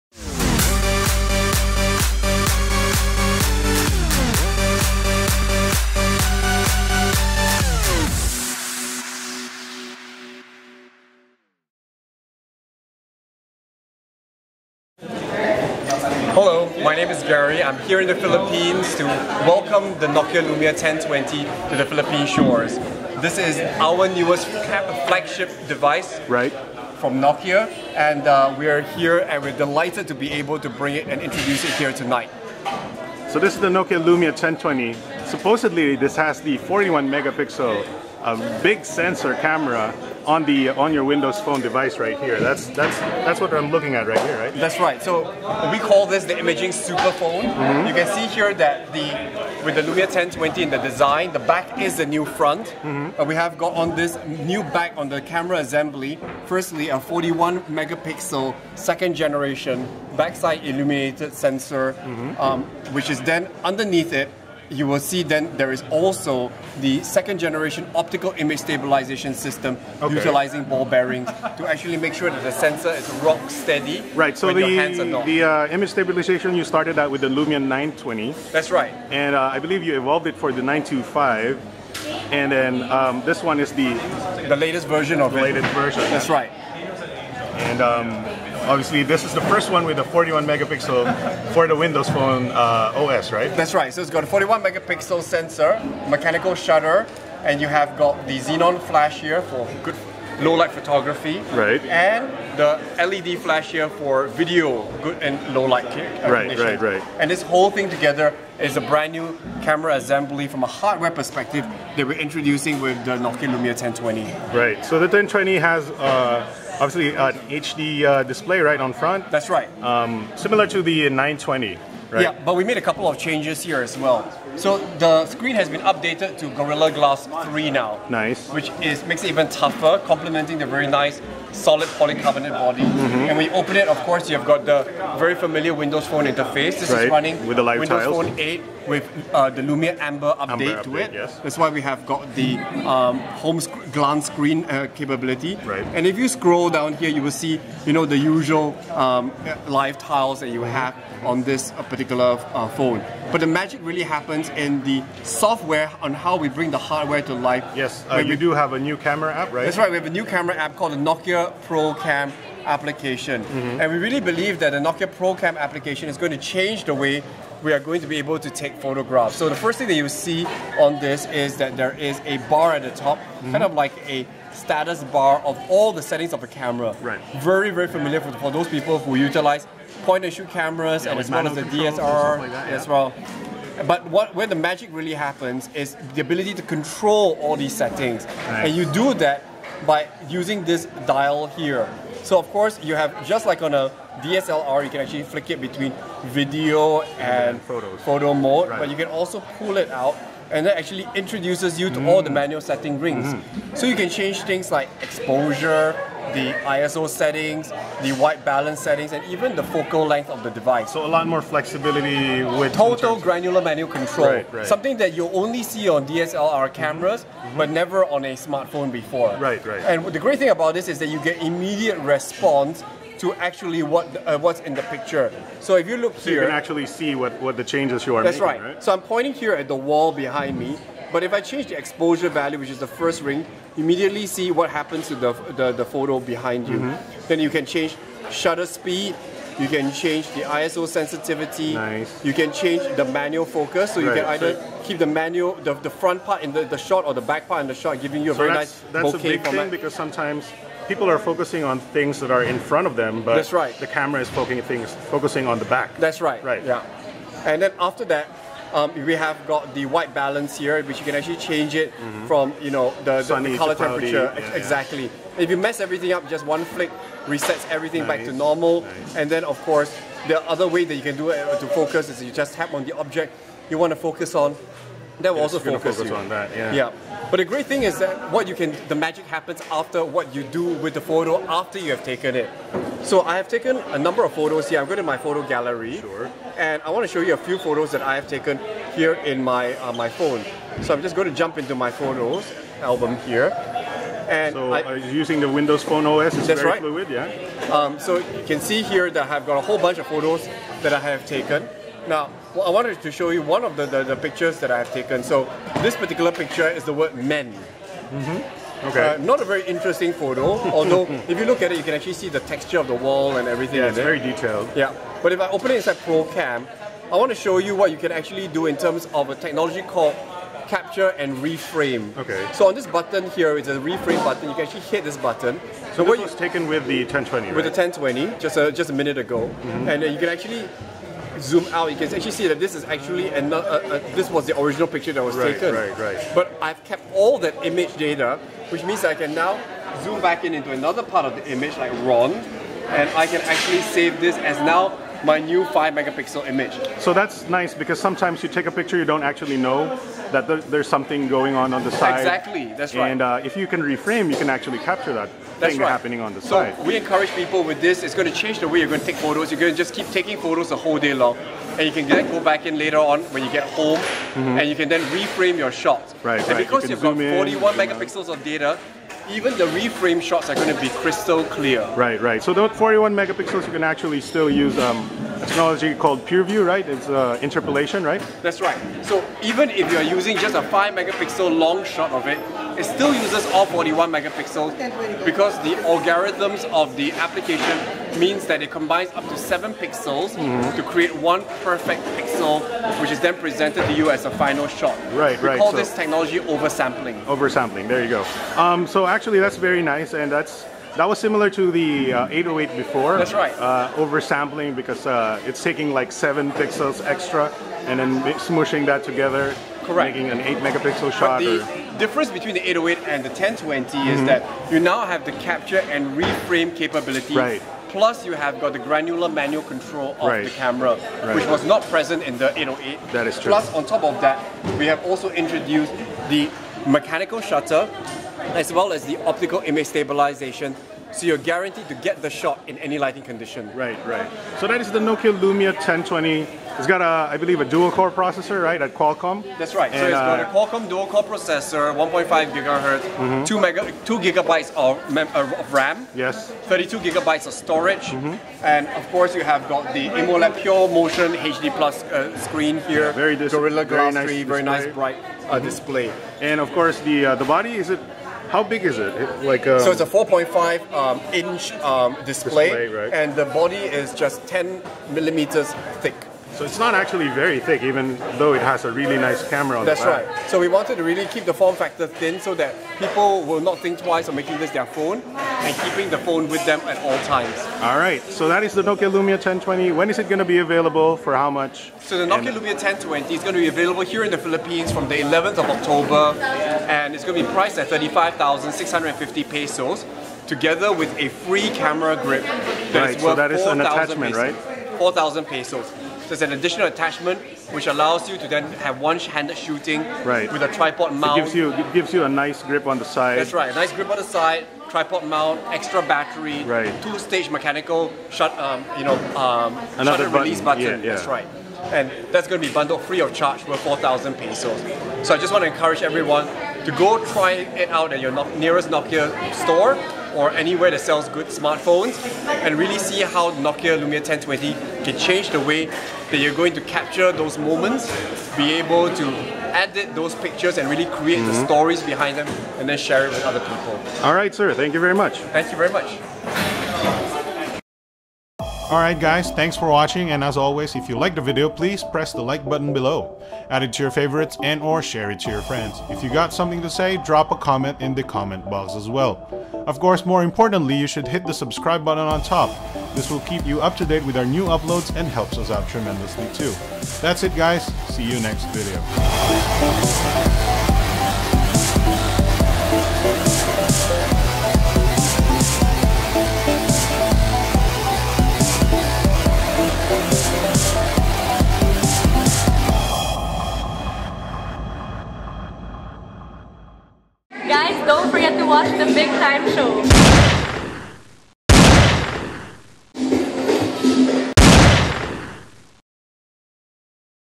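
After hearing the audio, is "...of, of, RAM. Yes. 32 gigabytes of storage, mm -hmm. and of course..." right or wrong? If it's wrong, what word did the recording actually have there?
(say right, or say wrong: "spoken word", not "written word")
right.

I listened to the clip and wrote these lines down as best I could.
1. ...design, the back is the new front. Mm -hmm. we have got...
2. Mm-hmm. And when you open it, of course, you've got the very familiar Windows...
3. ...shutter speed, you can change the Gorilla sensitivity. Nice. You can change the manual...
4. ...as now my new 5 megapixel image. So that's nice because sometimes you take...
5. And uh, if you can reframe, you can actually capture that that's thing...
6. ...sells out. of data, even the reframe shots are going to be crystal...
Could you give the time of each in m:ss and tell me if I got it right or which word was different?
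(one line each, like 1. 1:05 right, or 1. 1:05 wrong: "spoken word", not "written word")
1. 0:50 right
2. 2:12 right
3. 3:58 wrong: "ISO", not "Gorilla"
4. 5:44 right
5. 5:53 right
6. 6:07 wrong: "megapixels", not "sells".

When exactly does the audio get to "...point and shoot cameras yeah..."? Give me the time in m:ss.
3:00.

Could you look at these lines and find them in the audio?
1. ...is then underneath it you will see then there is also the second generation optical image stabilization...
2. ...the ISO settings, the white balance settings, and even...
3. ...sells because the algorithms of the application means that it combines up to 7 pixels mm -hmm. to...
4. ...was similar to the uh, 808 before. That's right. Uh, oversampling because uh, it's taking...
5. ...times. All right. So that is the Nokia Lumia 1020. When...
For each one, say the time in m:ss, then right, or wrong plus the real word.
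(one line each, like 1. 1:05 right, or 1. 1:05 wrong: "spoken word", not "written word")
1. 1:03 right
2. 3:26 right
3. 6:24 wrong: "megapixels", not "sells"
4. 6:41 right
5. 7:57 right.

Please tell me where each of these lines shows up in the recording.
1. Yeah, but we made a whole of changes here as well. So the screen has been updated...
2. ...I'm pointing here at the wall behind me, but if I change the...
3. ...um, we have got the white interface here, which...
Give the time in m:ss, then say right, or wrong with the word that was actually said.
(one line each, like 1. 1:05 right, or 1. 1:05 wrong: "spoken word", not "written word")
1. 2:02 wrong: "couple", not "whole"
2. 3:48 right
3. 4:18 wrong: "balance", not "interface".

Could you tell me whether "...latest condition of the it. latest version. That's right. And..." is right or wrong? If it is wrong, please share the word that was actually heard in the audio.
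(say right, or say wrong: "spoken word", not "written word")
wrong: "version", not "condition".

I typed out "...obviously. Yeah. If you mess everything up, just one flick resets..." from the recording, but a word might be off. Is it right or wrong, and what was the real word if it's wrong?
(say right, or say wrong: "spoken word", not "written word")
wrong: "exactly", not "obviously".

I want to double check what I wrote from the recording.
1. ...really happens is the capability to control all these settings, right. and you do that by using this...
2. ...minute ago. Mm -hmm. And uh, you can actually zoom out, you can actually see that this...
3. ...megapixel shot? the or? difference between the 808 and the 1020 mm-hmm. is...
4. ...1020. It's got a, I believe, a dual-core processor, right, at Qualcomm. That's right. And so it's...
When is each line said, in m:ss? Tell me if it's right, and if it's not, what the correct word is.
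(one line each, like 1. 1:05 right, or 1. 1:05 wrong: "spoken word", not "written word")
1. 3:04 wrong: "ability", not "capability"
2. 5:28 right
3. 6:50 right
4. 7:15 right.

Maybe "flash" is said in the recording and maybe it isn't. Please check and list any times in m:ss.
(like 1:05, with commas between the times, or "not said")
1:38, 1:43.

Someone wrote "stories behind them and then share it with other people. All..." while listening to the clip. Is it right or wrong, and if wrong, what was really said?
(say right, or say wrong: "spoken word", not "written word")
right.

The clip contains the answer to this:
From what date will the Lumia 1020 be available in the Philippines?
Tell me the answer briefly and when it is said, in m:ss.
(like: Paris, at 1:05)
11 October, at 8:05.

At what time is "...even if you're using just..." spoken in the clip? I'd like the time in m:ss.
6:19.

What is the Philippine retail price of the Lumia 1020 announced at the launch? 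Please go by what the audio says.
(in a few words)
35,650 pesos.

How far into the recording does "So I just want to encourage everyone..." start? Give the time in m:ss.
8:35.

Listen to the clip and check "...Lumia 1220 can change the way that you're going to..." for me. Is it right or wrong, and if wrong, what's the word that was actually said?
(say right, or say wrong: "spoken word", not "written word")
wrong: "1020", not "1220".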